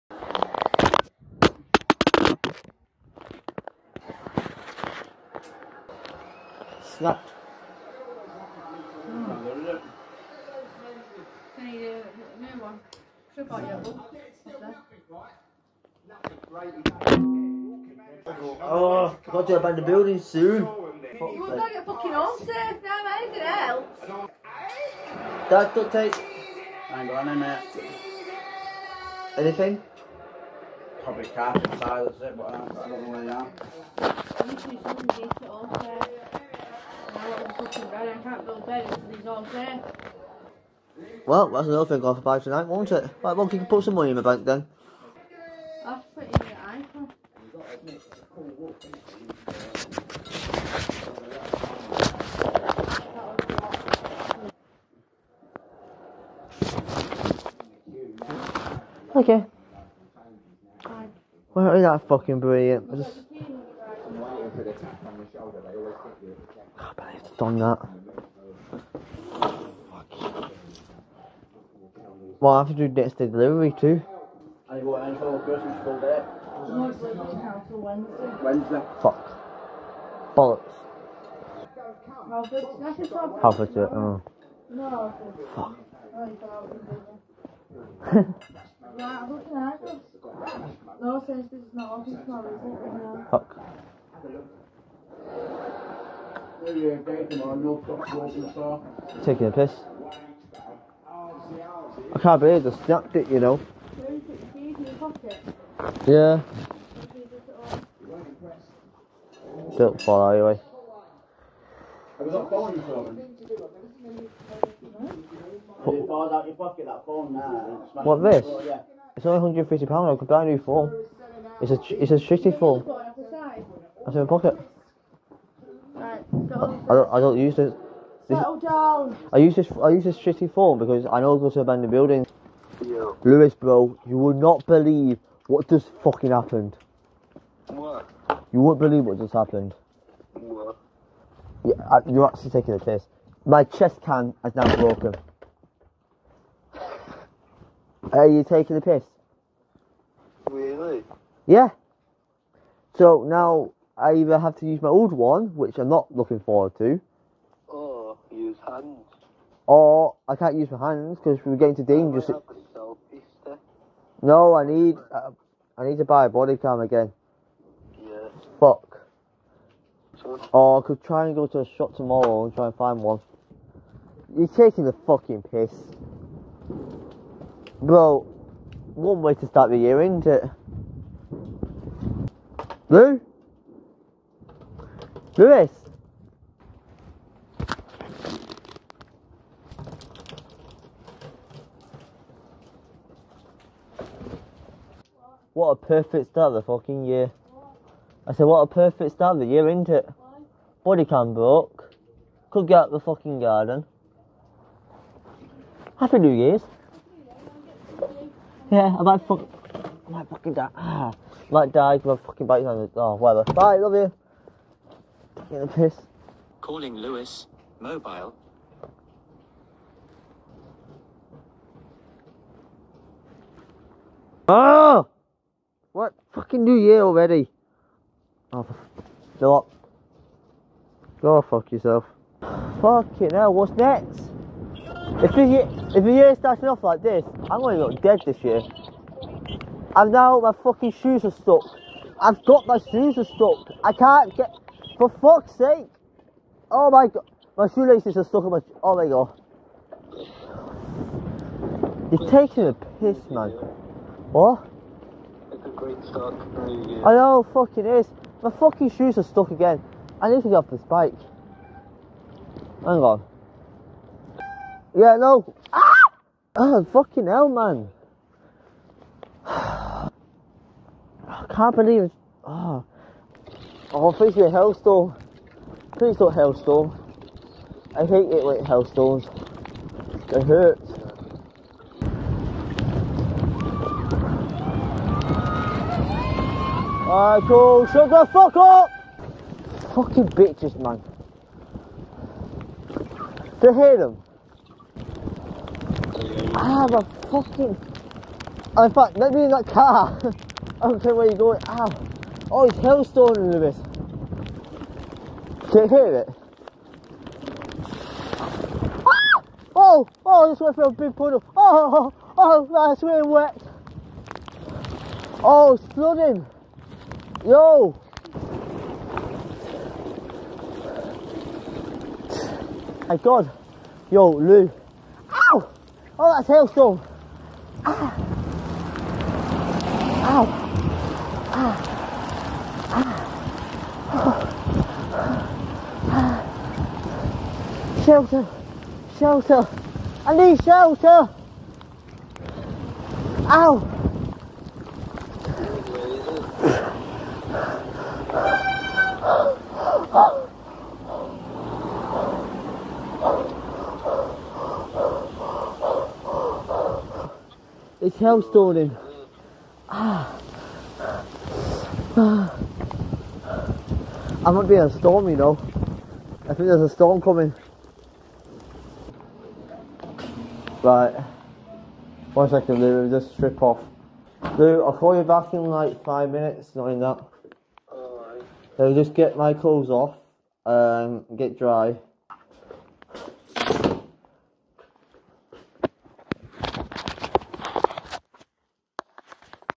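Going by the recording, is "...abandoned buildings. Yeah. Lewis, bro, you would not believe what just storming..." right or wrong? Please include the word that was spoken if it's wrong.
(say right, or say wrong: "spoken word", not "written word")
wrong: "fucking", not "storming".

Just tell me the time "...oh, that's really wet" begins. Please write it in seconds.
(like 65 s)
312 s.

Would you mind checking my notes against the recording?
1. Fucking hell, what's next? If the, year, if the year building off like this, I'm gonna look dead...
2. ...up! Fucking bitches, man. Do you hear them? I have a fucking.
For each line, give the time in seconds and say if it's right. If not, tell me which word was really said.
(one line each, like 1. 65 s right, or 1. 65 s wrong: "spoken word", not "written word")
1. 232 s wrong: "starting", not "building"
2. 288 s right.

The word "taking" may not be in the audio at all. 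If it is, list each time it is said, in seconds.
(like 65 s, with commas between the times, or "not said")
99 s, 142 s, 148 s, 174 s, 252 s.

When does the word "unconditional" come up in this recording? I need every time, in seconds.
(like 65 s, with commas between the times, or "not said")
not said.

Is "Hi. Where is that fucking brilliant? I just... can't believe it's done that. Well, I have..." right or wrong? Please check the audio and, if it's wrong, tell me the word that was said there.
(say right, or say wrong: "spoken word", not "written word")
right.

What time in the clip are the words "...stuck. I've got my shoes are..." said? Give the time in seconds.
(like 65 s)
241 s.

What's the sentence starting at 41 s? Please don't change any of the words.
Well, that's another thing off about tonight, won't it?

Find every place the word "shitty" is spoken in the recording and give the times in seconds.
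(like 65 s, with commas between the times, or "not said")
122 s, 130 s.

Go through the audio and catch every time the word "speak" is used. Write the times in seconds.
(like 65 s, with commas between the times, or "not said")
not said.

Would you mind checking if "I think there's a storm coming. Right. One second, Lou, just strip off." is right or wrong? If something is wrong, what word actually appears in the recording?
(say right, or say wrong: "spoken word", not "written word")
right.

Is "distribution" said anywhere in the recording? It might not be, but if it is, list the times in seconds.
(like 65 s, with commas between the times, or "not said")
not said.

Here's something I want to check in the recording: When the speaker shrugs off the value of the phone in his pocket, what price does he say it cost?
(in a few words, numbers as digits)
£150.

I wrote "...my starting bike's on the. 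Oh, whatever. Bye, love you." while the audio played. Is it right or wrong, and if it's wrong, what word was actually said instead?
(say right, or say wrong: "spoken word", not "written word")
wrong: "fucking", not "starting".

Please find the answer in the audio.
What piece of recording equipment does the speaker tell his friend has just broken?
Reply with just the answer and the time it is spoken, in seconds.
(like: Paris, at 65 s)
chest cam, at 143 s.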